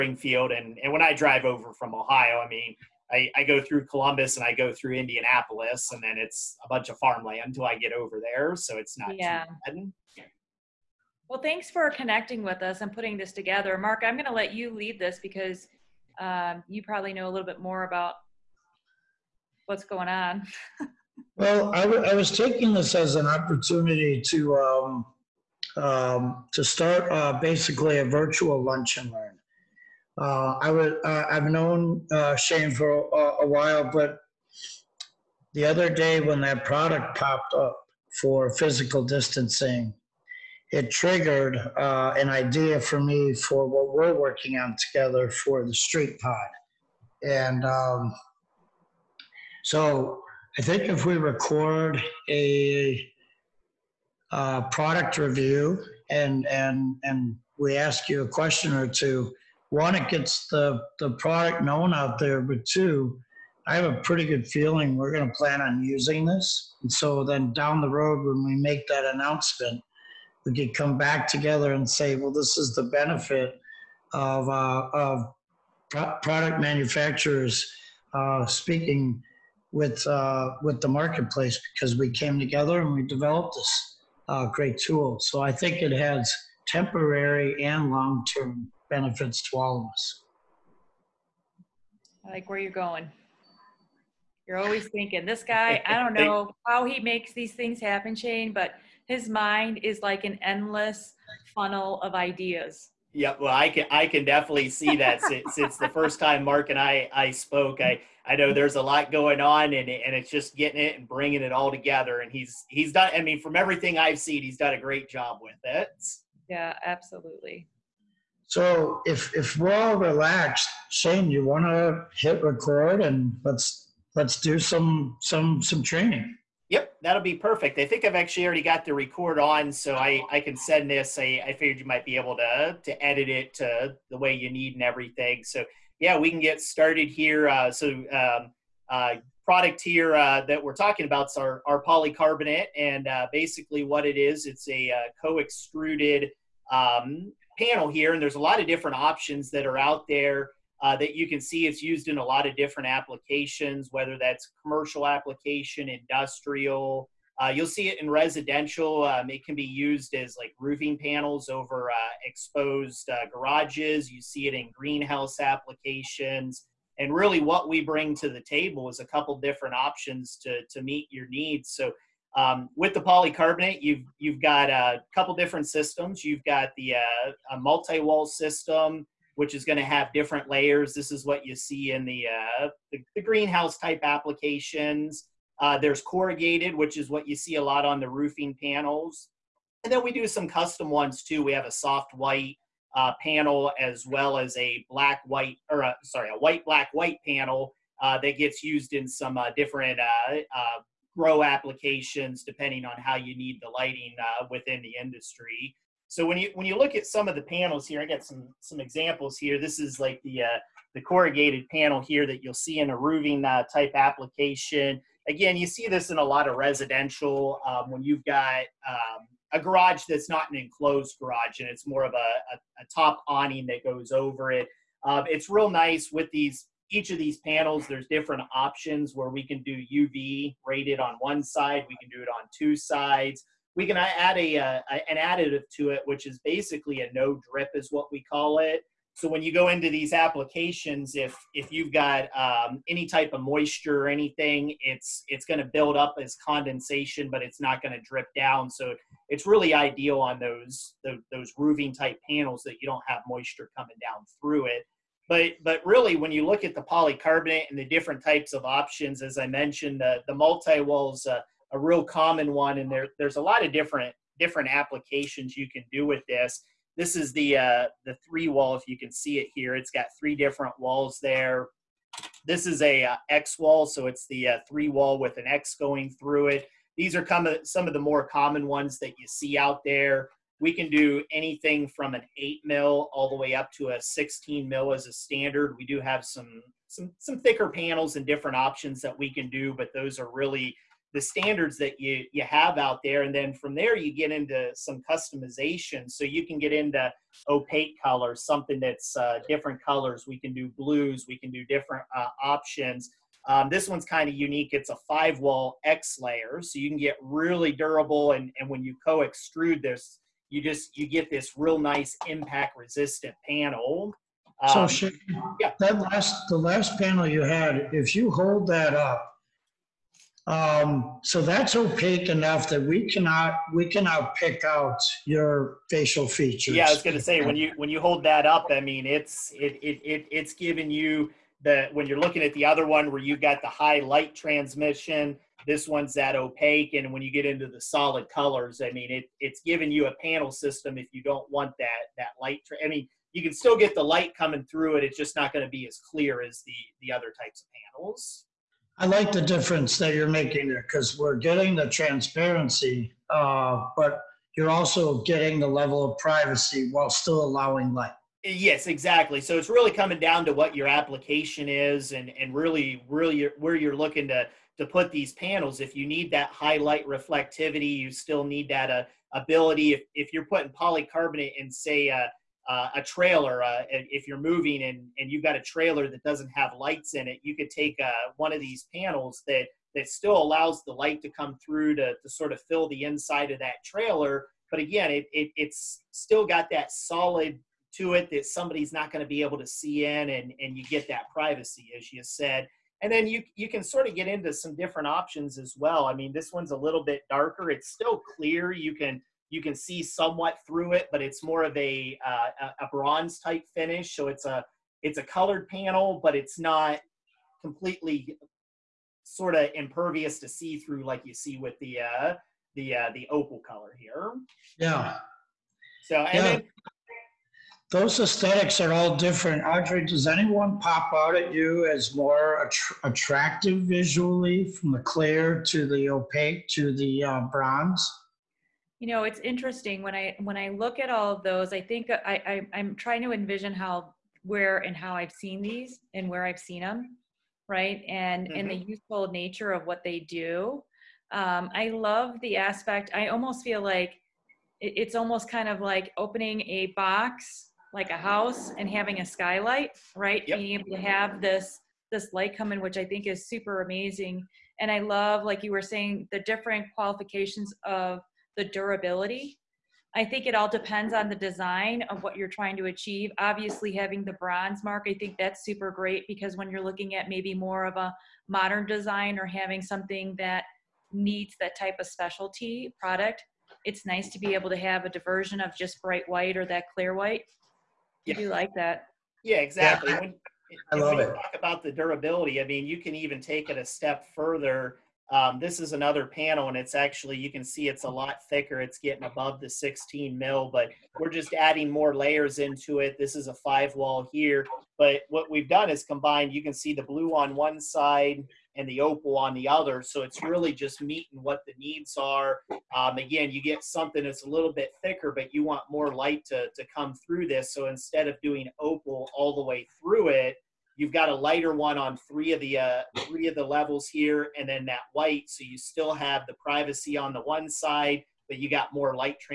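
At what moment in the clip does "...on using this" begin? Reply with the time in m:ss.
1:05.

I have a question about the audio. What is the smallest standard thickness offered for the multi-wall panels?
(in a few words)
8 mil.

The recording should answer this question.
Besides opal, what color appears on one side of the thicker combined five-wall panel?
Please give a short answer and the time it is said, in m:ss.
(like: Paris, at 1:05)
blue, at 8:17.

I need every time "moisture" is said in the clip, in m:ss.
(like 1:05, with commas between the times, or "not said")
4:03, 4:13.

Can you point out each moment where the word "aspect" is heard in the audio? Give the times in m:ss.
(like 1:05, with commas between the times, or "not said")
7:22.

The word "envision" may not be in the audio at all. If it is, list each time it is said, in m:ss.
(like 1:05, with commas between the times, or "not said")
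7:13.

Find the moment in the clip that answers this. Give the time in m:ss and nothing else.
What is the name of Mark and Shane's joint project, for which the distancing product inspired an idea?
0:45.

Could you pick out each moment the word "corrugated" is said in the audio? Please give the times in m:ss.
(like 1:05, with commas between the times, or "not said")
3:06, 3:30.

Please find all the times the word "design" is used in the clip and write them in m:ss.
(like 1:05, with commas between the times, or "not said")
7:41, 7:48.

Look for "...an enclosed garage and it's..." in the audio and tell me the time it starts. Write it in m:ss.
3:40.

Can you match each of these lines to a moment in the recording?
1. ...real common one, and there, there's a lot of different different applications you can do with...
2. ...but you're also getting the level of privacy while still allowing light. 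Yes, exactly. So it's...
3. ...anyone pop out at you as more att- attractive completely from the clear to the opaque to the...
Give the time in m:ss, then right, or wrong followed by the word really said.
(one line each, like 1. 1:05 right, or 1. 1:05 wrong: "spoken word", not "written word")
1. 4:21 right
2. 5:53 right
3. 7:00 wrong: "visually", not "completely".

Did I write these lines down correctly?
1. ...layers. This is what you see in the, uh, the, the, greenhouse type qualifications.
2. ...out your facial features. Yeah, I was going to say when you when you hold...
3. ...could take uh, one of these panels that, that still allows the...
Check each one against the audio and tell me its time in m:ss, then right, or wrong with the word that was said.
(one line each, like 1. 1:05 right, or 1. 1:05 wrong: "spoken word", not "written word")
1. 3:00 wrong: "applications", not "qualifications"
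2. 5:24 right
3. 6:17 right.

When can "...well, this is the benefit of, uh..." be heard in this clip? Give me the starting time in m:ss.
1:12.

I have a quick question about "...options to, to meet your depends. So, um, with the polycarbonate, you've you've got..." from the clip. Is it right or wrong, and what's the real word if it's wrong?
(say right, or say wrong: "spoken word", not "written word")
wrong: "needs", not "depends".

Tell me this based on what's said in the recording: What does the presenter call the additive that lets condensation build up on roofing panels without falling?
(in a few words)
no drip.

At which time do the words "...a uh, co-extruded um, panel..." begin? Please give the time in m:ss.
2:24.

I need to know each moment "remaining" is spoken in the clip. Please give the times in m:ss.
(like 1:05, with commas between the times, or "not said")
not said.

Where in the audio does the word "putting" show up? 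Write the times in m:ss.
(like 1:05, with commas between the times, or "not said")
0:12, 6:10.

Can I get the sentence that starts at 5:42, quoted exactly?
Tra- I mean you can still get the light coming through it.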